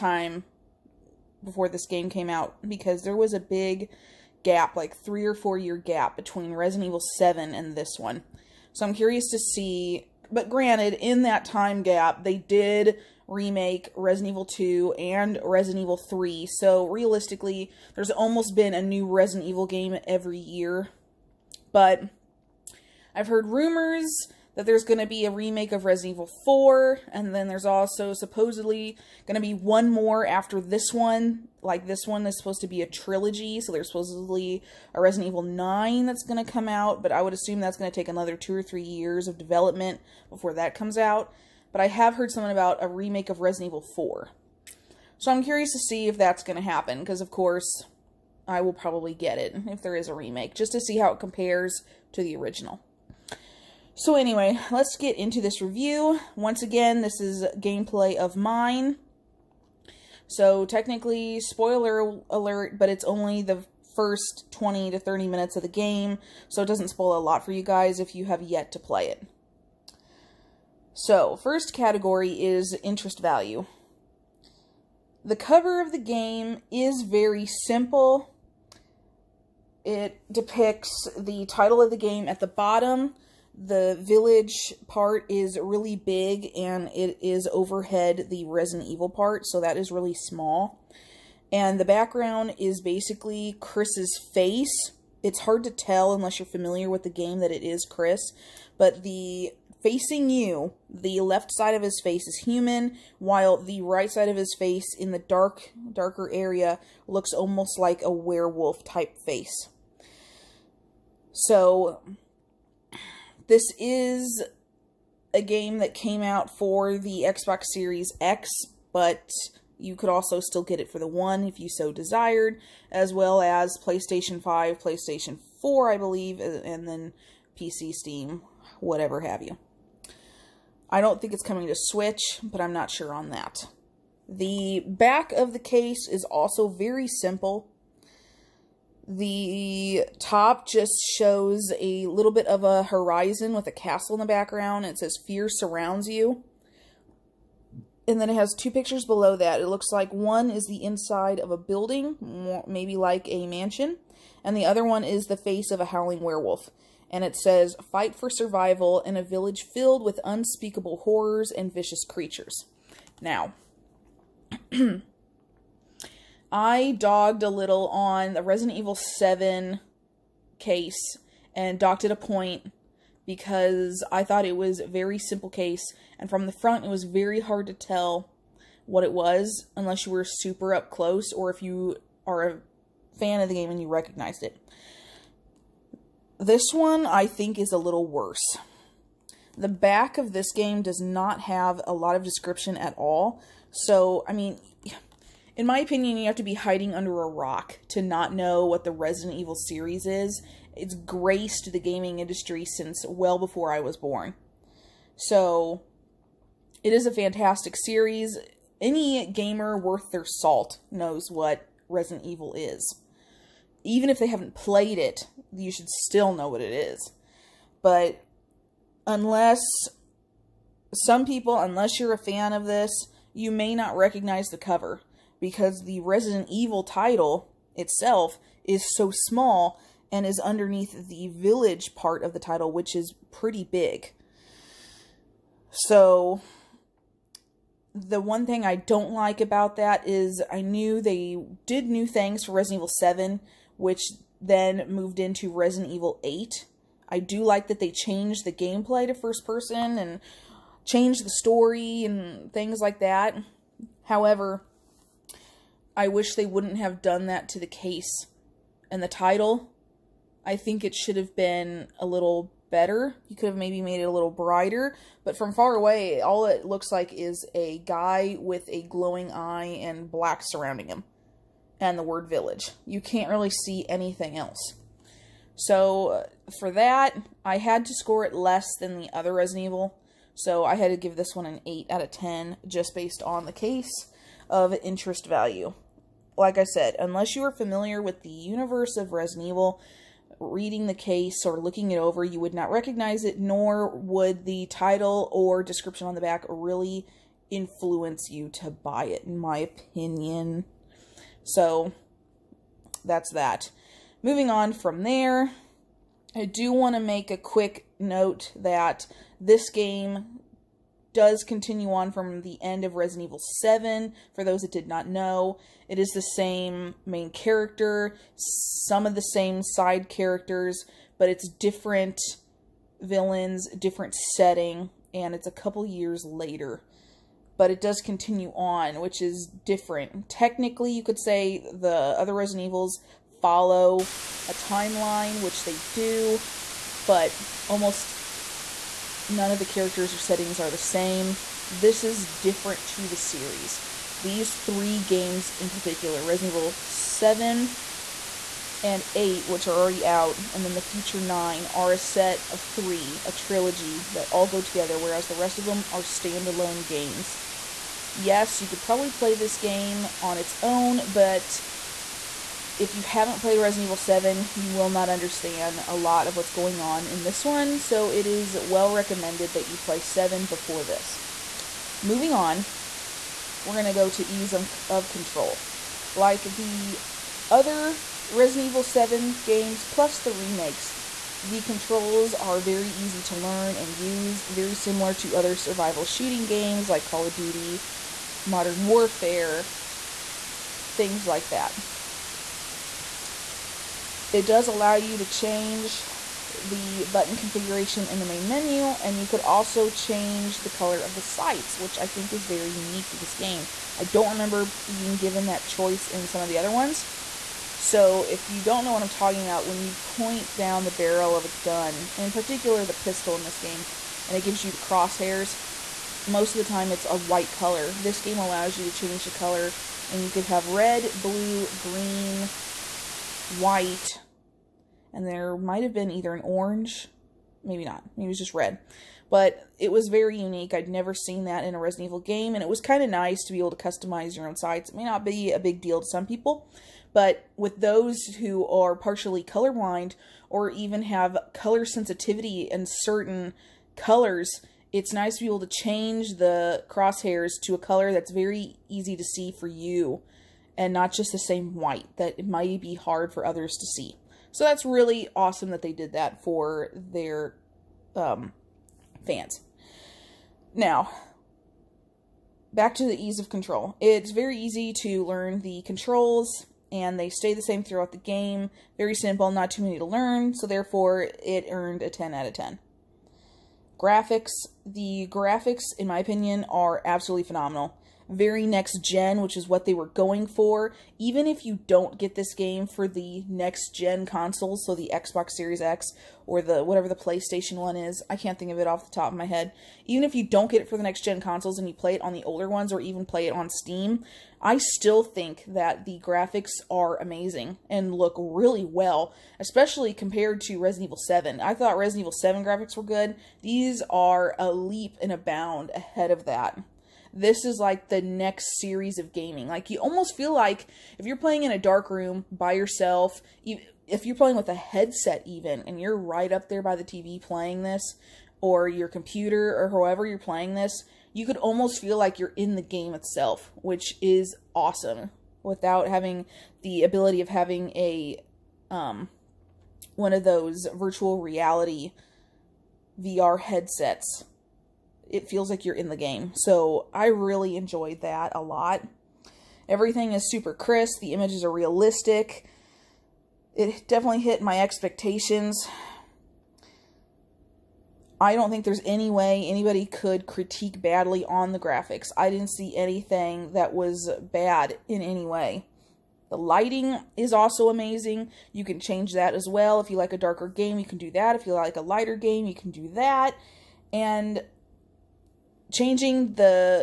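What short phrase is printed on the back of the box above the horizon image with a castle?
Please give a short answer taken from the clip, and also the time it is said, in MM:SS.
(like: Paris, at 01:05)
Fear surrounds you, at 02:25.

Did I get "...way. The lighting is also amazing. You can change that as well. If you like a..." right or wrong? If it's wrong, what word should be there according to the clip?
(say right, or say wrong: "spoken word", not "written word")
right.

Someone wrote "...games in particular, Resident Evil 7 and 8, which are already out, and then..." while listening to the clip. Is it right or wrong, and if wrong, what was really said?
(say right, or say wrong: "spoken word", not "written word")
right.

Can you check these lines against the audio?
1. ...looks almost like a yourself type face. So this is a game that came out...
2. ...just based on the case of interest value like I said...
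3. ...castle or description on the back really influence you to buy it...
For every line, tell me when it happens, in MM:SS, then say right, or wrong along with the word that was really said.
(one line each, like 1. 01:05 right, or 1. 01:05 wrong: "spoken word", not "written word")
1. 01:47 wrong: "werewolf", not "yourself"
2. 04:42 right
3. 04:54 wrong: "title", not "castle".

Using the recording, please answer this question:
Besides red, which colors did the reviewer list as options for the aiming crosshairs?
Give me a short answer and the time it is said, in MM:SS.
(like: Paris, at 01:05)
Blue, green, white, at 07:01.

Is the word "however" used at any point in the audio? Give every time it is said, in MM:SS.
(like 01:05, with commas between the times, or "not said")
04:14, 08:39.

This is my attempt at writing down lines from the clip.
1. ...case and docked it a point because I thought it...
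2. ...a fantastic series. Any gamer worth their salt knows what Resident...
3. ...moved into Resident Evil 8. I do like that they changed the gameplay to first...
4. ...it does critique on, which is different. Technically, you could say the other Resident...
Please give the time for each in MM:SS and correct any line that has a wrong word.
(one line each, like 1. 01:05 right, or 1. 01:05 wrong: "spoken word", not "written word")
1. 02:50 right
2. 03:27 right
3. 04:04 right
4. 05:27 wrong: "continue", not "critique".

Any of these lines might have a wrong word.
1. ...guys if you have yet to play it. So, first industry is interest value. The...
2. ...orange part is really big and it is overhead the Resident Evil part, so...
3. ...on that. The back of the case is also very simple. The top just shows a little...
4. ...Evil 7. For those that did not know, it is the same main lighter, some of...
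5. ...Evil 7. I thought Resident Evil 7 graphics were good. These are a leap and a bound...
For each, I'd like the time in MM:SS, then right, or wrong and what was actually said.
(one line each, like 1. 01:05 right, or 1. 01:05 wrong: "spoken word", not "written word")
1. 01:07 wrong: "category", not "industry"
2. 01:24 wrong: "village", not "orange"
3. 02:13 right
4. 05:13 wrong: "character", not "lighter"
5. 08:21 right.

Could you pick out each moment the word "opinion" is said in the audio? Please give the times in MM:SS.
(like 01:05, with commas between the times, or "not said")
03:15, 04:59, 07:56.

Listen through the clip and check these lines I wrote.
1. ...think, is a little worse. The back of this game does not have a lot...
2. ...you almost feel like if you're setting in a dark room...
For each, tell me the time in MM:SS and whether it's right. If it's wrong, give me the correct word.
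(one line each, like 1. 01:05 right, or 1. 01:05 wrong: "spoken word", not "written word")
1. 03:07 right
2. 08:29 wrong: "playing", not "setting".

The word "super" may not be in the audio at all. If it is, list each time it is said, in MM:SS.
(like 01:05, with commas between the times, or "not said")
03:00, 09:00.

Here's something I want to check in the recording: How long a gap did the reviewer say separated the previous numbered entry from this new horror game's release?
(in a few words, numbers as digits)
3 or 4 years.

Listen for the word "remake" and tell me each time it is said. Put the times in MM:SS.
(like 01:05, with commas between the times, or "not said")
00:13, 00:25, 00:42, 00:50, 06:20.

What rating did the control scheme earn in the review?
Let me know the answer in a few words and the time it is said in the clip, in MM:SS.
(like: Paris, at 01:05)
10 out of 10, at 07:52.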